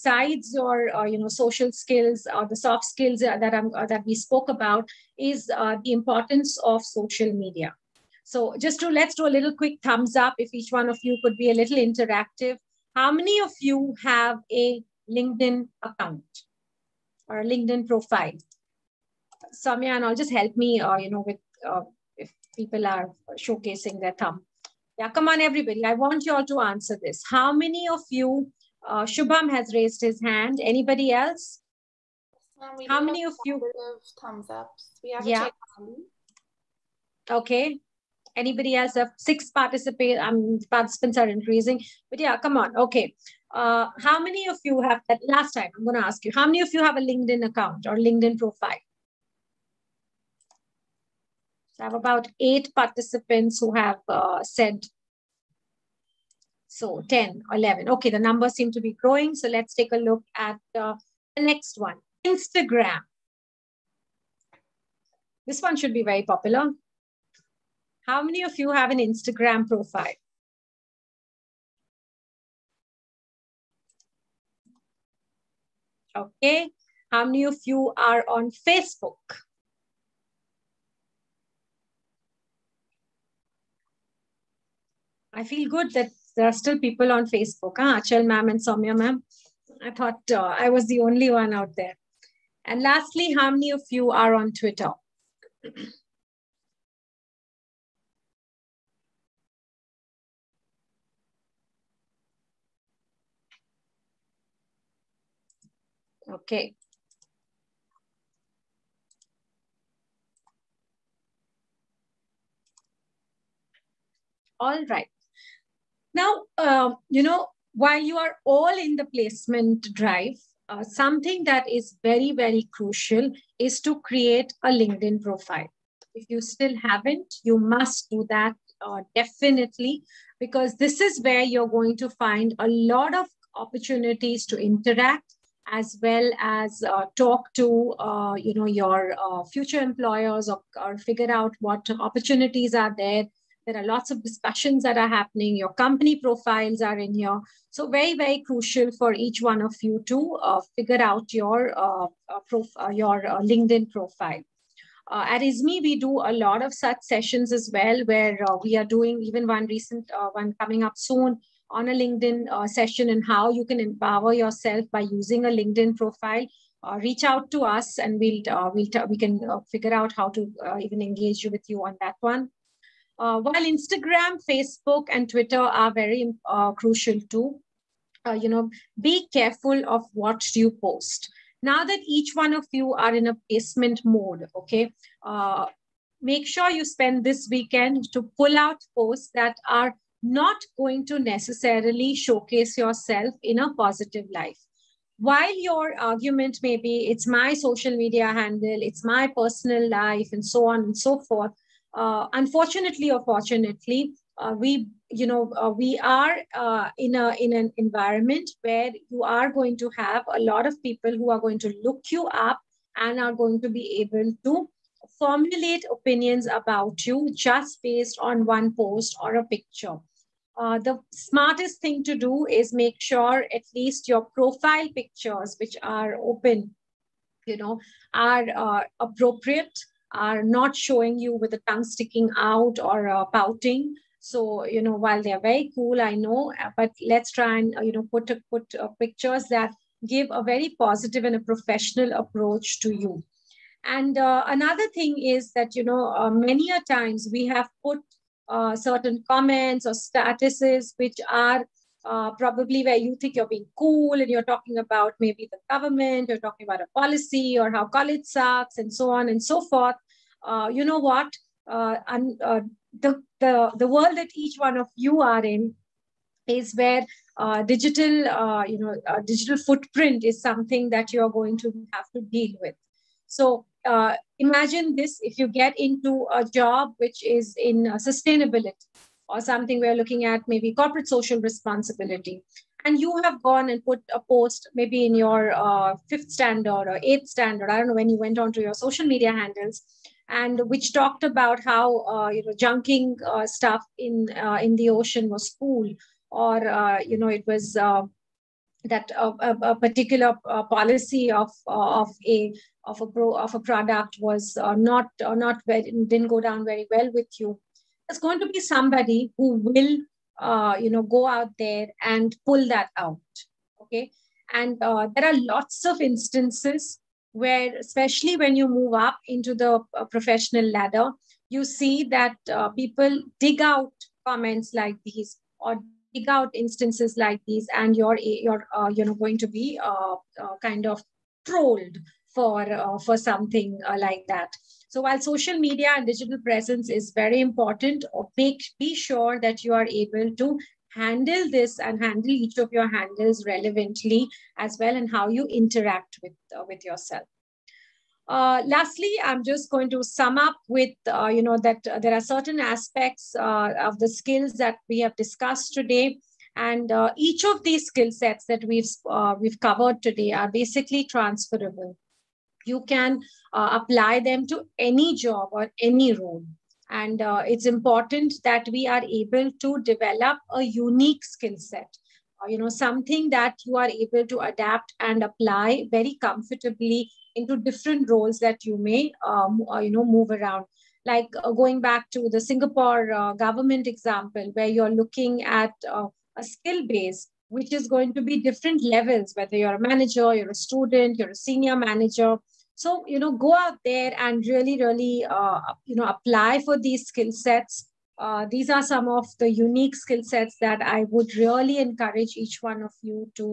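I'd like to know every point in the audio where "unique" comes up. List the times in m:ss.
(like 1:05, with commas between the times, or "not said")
6:10, 6:39.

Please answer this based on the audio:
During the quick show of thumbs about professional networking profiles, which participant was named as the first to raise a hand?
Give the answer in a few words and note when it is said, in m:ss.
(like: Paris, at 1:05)
Shubham, at 0:29.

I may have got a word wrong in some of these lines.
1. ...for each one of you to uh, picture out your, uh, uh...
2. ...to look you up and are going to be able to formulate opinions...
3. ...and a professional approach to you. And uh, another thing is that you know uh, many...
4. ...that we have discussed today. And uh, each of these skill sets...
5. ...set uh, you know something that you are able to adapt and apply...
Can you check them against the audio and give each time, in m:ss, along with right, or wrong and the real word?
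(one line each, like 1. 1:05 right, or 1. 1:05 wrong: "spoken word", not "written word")
1. 2:28 wrong: "figure", not "picture"
2. 3:31 right
3. 4:01 right
4. 5:54 right
5. 6:11 right.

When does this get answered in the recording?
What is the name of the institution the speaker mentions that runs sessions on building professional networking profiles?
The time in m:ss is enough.
2:35.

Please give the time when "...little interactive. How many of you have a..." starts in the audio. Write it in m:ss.
0:11.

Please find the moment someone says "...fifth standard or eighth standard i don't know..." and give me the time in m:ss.
4:46.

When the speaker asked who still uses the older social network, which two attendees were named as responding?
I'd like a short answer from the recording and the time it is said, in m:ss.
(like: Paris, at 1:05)
Achal ma'am and Soumya ma'am, at 1:28.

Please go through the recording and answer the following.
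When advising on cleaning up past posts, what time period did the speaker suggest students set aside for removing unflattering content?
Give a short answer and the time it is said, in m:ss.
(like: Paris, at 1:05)
this weekend, at 3:07.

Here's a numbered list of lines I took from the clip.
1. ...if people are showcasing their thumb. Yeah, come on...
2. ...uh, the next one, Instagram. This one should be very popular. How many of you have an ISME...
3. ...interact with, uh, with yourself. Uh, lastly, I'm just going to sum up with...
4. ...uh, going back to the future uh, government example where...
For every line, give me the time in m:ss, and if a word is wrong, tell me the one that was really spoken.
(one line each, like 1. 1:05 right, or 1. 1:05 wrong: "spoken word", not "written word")
1. 0:22 right
2. 1:00 wrong: "Instagram", not "ISME"
3. 5:45 right
4. 6:21 wrong: "singapore", not "future".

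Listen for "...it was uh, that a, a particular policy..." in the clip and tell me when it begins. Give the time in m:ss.
4:57.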